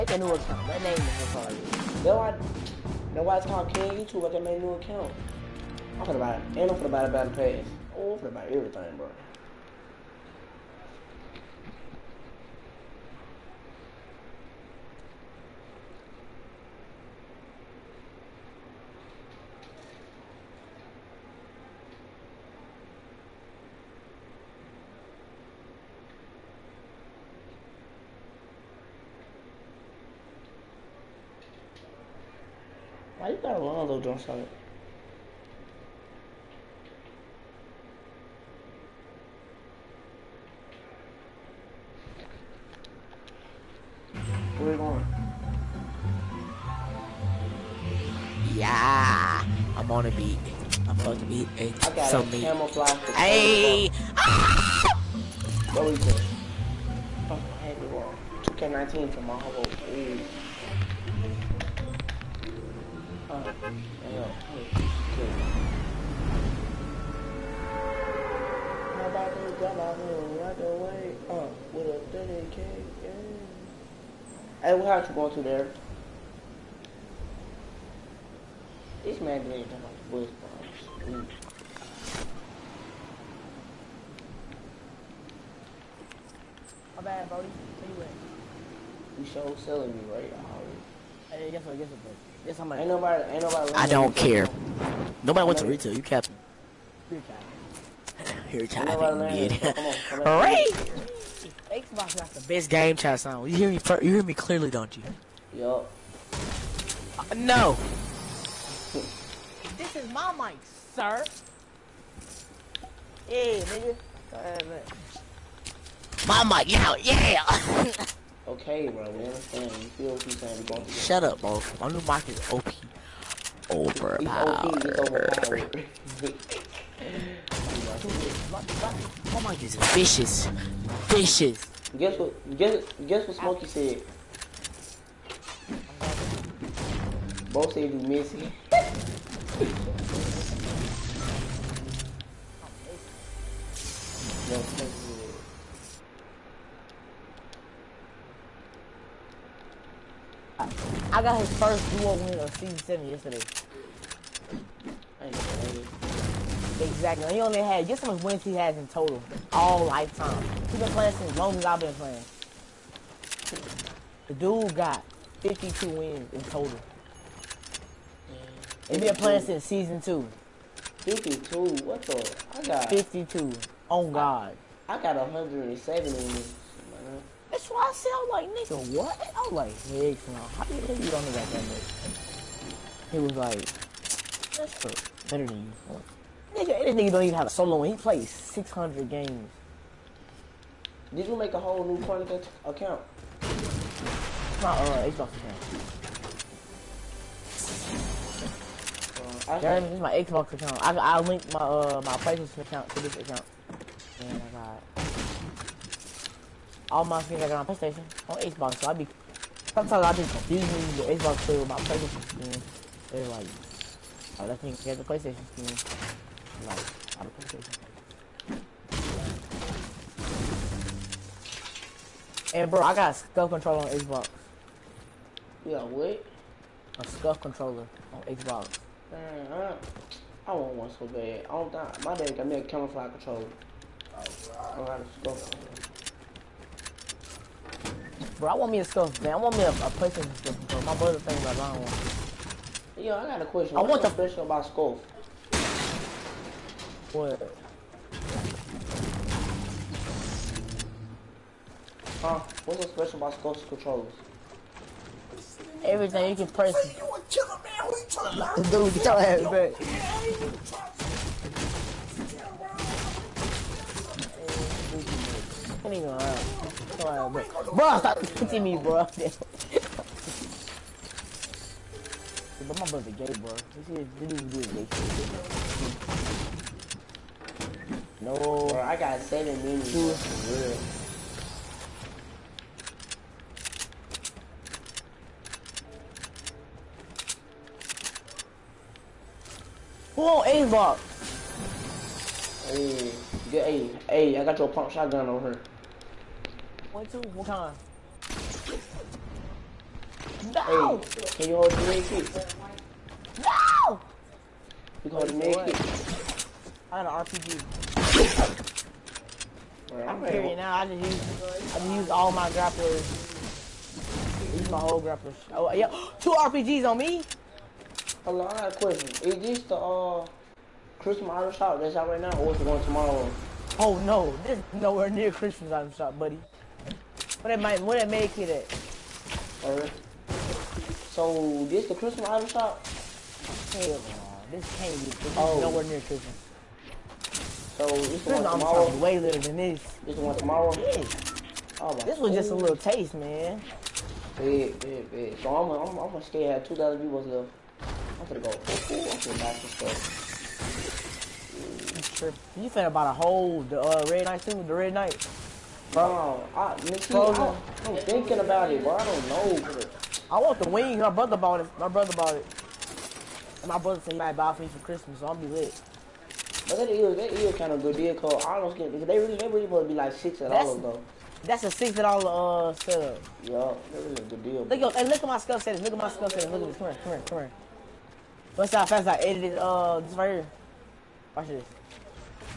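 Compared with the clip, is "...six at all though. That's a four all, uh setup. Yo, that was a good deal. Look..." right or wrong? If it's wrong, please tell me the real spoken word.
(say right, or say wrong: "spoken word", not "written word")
wrong: "six", not "four".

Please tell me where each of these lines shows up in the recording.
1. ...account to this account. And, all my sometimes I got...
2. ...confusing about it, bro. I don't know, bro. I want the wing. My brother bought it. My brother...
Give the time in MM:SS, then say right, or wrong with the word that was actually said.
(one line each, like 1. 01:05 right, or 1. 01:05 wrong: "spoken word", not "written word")
1. 03:22 wrong: "games", not "sometimes"
2. 05:58 wrong: "thinking", not "confusing".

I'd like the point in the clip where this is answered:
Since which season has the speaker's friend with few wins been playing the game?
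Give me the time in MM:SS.
02:49.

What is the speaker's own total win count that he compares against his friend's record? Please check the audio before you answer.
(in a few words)
170.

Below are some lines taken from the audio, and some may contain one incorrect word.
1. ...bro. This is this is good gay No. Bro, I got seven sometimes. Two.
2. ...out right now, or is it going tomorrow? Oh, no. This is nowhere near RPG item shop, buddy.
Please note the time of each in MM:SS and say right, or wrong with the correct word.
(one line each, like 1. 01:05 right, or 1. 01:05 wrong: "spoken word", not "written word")
1. 04:33 wrong: "minutes", not "sometimes"
2. 05:21 wrong: "Christmas", not "RPG".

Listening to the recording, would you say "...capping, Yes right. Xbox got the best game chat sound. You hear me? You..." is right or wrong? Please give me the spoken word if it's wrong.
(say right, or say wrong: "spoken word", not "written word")
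wrong: "All", not "Yes".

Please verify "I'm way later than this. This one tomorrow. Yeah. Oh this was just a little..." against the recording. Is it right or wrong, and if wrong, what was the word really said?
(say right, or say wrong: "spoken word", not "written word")
right.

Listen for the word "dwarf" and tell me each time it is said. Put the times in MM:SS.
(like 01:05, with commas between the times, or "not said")
not said.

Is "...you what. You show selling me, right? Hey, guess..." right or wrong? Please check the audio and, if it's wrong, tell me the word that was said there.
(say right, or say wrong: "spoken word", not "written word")
right.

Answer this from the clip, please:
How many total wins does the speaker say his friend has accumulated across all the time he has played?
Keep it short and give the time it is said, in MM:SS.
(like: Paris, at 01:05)
52, at 02:45.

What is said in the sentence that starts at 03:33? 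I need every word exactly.
They're like, oh, that thing has a PlayStation skin.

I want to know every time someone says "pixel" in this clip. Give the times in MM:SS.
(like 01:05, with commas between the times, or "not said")
not said.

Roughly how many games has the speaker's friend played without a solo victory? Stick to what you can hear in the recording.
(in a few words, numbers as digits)
600.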